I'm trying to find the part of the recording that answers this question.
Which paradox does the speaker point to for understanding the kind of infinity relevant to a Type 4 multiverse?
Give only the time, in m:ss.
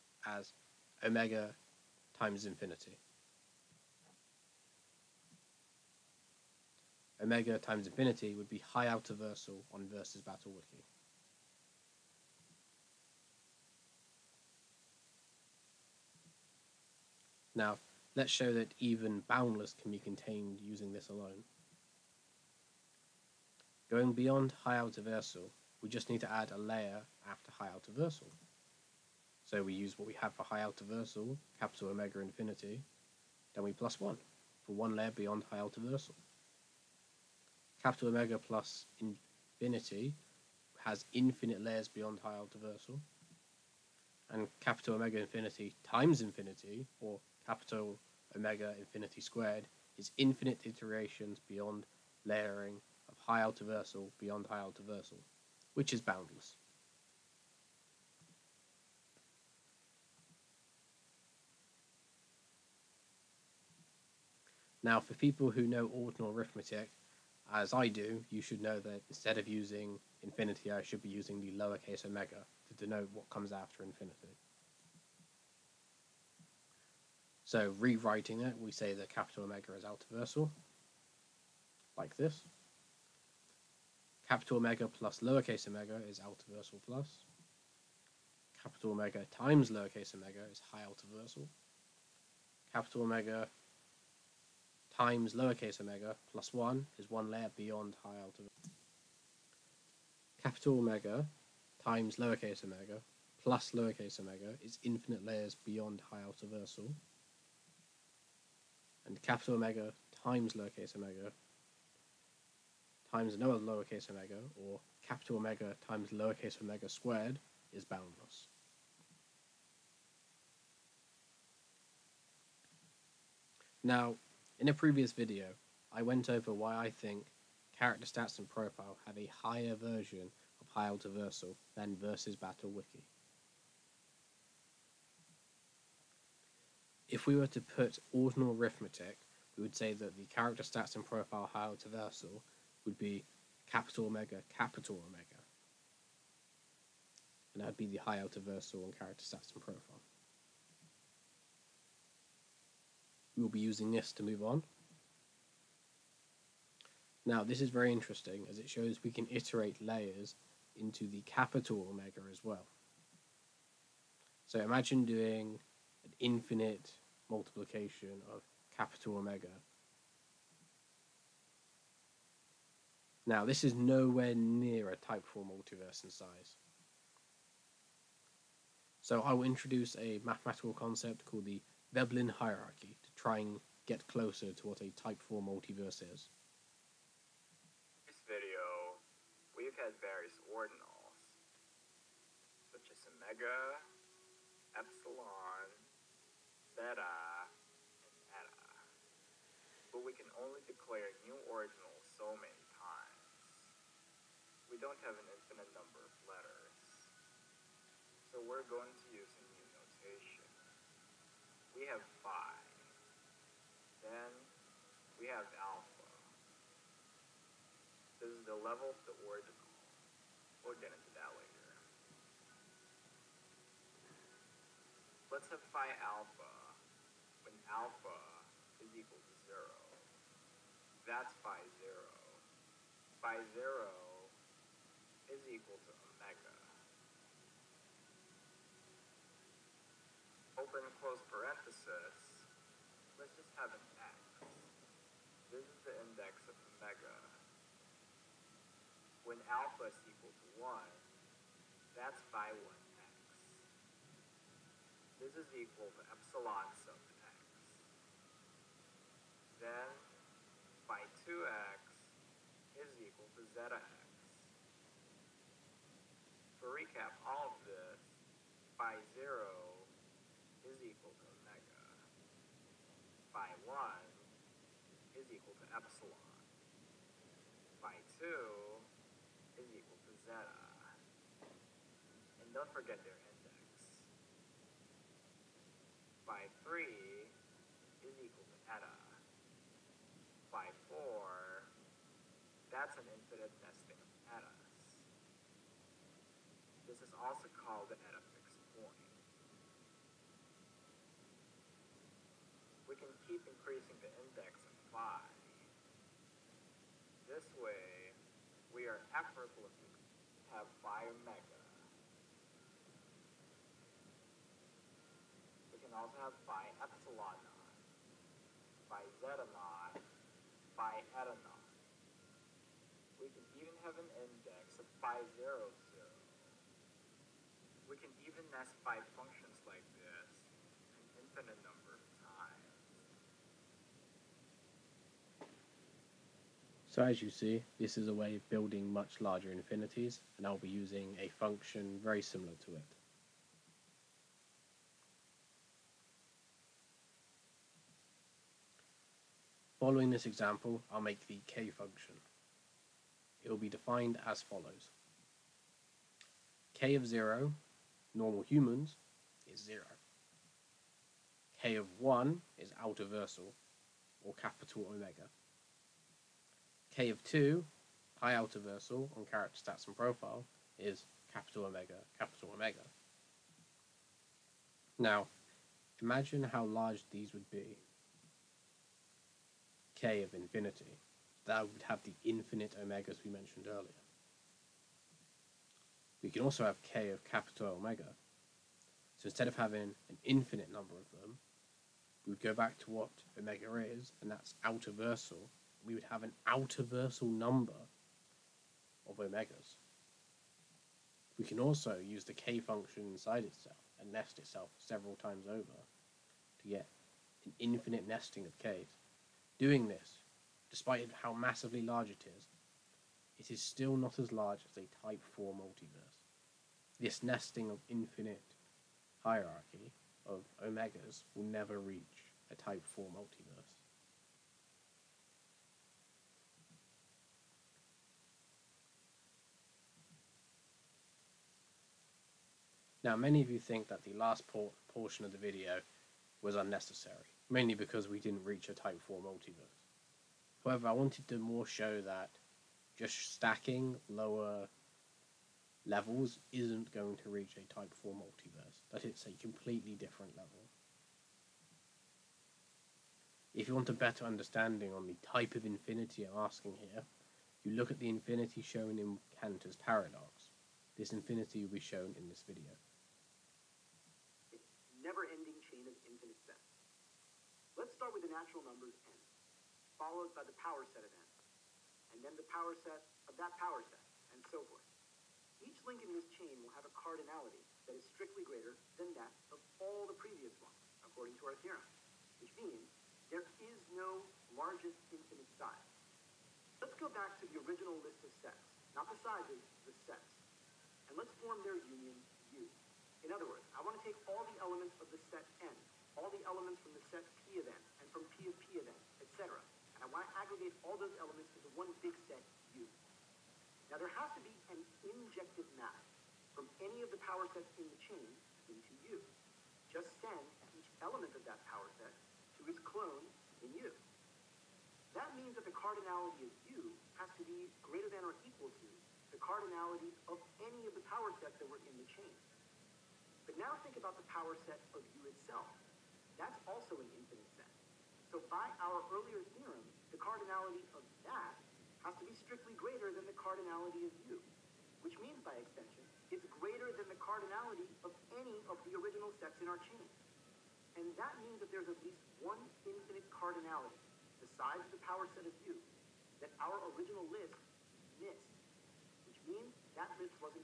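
7:39.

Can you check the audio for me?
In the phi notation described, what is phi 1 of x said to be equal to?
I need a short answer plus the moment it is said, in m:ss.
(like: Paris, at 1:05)
Epsilon sub x, at 4:16.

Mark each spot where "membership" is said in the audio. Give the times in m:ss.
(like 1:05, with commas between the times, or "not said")
not said.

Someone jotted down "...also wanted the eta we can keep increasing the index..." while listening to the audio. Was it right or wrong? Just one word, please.
wrong.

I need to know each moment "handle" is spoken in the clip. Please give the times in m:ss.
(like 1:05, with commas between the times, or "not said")
not said.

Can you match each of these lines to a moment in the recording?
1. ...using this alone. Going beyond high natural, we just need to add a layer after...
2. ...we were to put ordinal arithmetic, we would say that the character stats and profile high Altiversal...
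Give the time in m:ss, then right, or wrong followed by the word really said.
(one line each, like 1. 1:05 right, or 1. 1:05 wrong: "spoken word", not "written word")
1. 0:20 wrong: "altiversal", not "natural"
2. 2:17 right.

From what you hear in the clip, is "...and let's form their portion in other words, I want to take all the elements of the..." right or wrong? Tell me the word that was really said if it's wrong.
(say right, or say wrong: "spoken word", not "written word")
wrong: "union", not "portion".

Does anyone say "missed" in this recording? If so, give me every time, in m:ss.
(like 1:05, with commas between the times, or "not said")
9:08.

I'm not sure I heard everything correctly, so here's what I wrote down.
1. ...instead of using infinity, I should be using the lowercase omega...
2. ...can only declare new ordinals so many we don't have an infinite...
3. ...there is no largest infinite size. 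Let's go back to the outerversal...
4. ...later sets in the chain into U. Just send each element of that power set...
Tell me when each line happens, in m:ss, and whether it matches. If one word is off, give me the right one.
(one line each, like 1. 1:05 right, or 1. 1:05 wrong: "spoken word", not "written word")
1. 1:09 right
2. 3:20 right
3. 8:03 wrong: "original", not "outerversal"
4. 8:27 wrong: "power", not "later".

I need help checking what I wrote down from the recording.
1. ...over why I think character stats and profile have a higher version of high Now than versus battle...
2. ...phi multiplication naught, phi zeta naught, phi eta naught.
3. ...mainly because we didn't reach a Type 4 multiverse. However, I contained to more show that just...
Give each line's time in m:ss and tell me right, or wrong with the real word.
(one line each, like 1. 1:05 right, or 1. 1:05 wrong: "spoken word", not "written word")
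1. 2:06 wrong: "Altiversal", not "Now"
2. 5:16 wrong: "epsilon", not "multiplication"
3. 7:17 wrong: "wanted", not "contained".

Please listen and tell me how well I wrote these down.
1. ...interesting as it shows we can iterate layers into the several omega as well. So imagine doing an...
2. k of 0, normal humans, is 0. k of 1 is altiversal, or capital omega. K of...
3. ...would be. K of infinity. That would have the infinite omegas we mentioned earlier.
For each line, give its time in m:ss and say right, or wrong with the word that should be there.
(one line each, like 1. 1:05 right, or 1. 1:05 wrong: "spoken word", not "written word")
1. 2:37 wrong: "capital", not "several"
2. 5:56 right
3. 6:17 right.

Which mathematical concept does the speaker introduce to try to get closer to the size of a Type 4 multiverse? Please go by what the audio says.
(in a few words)
Veblen hierarchy.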